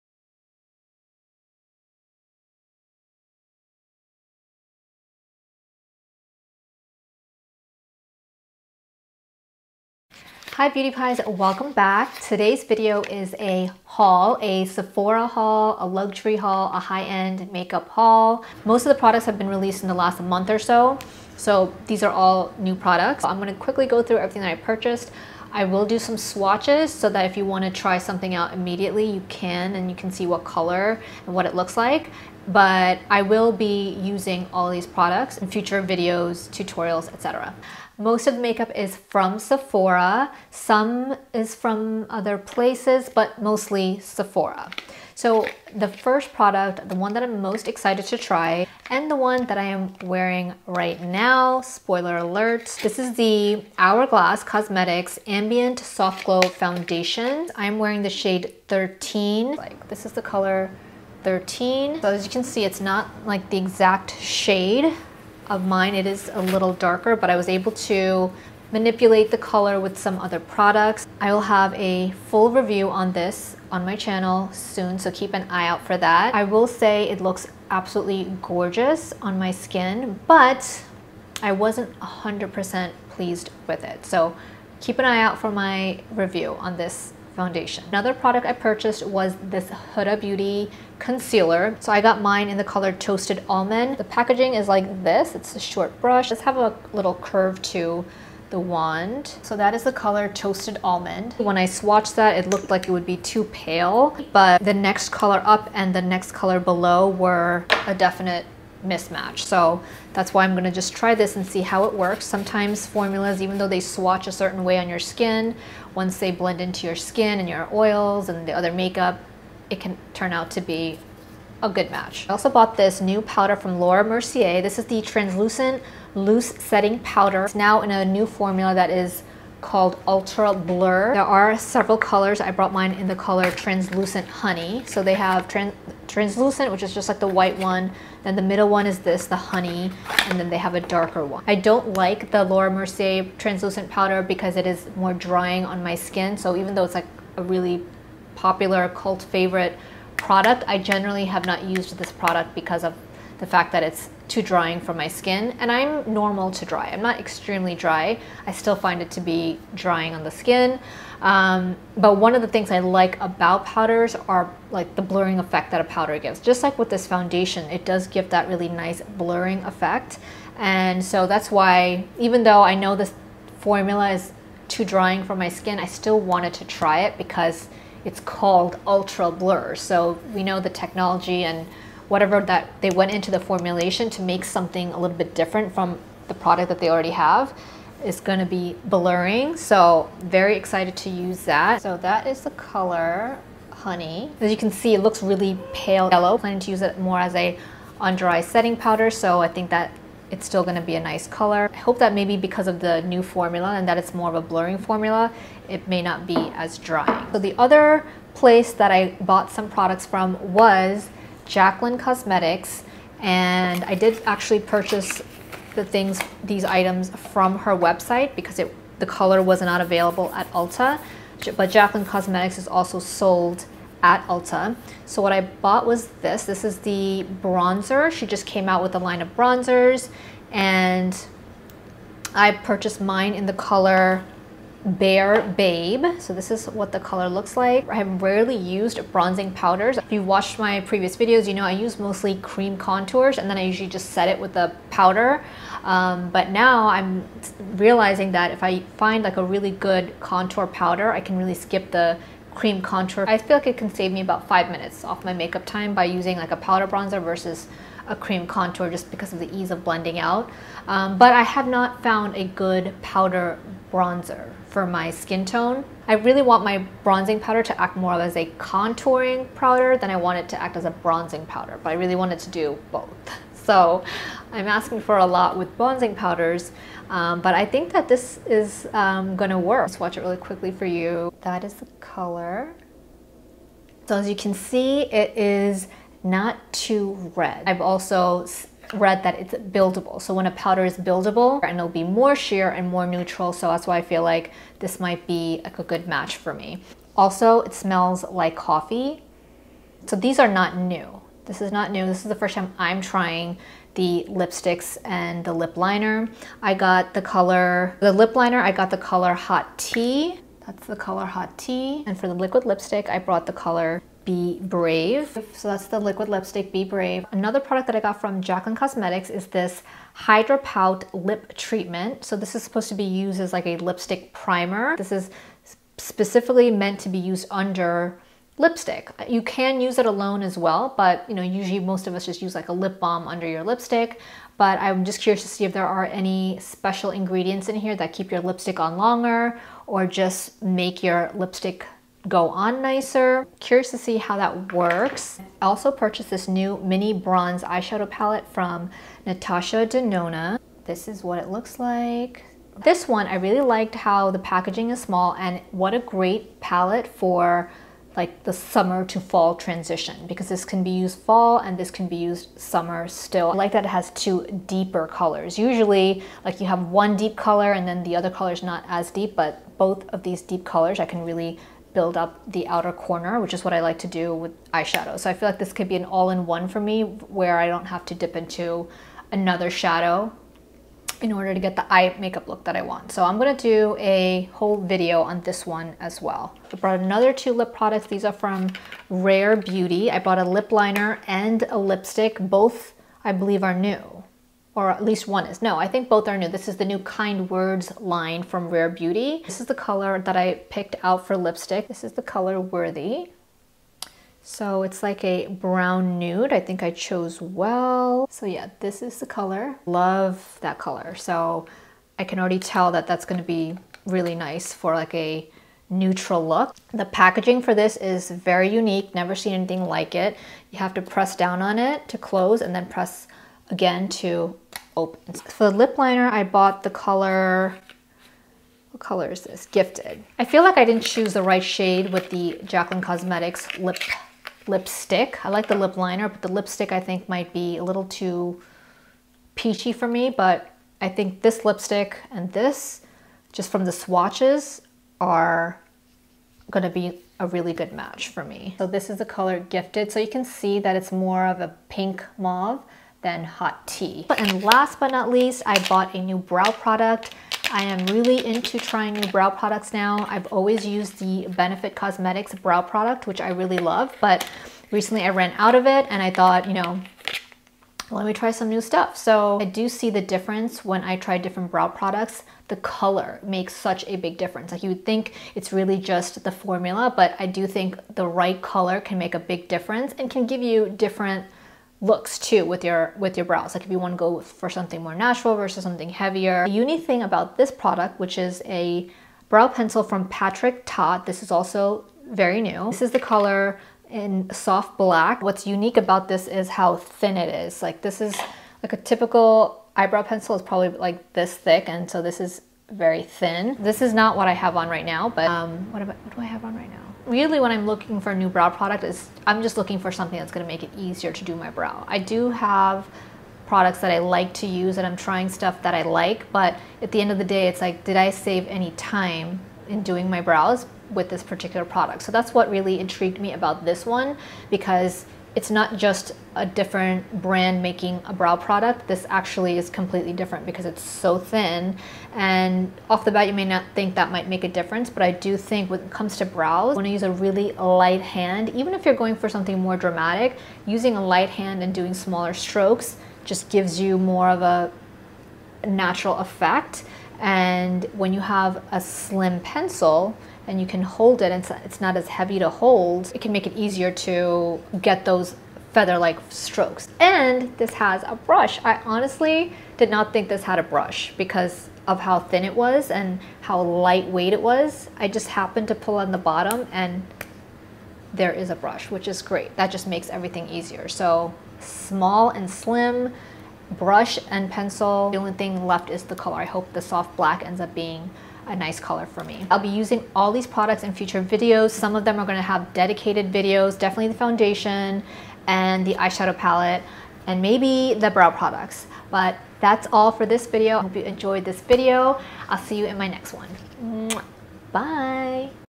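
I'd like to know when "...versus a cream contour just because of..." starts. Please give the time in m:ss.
4:17.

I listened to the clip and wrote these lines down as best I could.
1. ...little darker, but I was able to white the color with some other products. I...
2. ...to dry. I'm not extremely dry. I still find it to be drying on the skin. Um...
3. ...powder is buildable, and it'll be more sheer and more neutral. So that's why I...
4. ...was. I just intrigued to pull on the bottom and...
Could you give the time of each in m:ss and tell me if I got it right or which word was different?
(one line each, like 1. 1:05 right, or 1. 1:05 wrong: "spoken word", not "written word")
1. 1:06 wrong: "manipulate", not "white"
2. 2:36 right
3. 4:50 right
4. 9:24 wrong: "happened", not "intrigued".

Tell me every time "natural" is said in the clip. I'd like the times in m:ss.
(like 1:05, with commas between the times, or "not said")
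8:05, 9:05.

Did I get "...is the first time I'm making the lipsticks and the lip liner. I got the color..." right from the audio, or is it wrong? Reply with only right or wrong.
wrong.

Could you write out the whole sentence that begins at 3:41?
But Jaclyn Cosmetics is also sold at Ulta.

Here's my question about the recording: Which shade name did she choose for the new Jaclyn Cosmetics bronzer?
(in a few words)
Bare Babe.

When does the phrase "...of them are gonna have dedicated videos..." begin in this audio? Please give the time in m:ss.
9:42.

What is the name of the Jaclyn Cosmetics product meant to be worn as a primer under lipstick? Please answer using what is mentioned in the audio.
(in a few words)
Hydrapout Lip Treatment.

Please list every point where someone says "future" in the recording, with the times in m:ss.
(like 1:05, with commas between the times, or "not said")
0:35, 9:41.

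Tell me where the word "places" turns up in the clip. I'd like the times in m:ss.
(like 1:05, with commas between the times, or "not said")
0:42, 3:28.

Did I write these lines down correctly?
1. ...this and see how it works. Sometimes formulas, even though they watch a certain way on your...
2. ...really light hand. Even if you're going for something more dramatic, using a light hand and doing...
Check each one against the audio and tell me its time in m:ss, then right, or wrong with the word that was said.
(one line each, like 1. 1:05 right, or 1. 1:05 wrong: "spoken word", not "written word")
1. 1:51 wrong: "swatch", not "watch"
2. 8:57 right.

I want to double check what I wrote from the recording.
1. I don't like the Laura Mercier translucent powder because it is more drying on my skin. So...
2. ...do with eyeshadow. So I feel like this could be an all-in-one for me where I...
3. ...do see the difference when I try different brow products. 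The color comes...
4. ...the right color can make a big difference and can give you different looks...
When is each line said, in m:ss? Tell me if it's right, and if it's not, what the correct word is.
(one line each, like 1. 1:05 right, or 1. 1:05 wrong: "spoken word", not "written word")
1. 2:21 right
2. 6:14 right
3. 7:49 wrong: "makes", not "comes"
4. 7:58 right.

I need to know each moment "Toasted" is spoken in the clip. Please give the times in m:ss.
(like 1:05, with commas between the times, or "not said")
1:32, 1:40.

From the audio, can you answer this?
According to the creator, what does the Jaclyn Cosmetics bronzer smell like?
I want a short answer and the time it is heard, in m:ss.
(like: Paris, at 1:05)
Coffee, at 4:58.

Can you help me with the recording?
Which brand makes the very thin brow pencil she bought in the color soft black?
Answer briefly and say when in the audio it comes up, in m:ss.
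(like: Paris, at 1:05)
Patrick Ta, at 8:10.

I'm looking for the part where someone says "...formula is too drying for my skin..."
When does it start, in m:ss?
2:53.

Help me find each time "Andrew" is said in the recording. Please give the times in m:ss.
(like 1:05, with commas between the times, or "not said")
not said.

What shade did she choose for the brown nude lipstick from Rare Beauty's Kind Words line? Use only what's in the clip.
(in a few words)
Worthy.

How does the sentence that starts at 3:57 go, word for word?
I have rarely used bronzing powders.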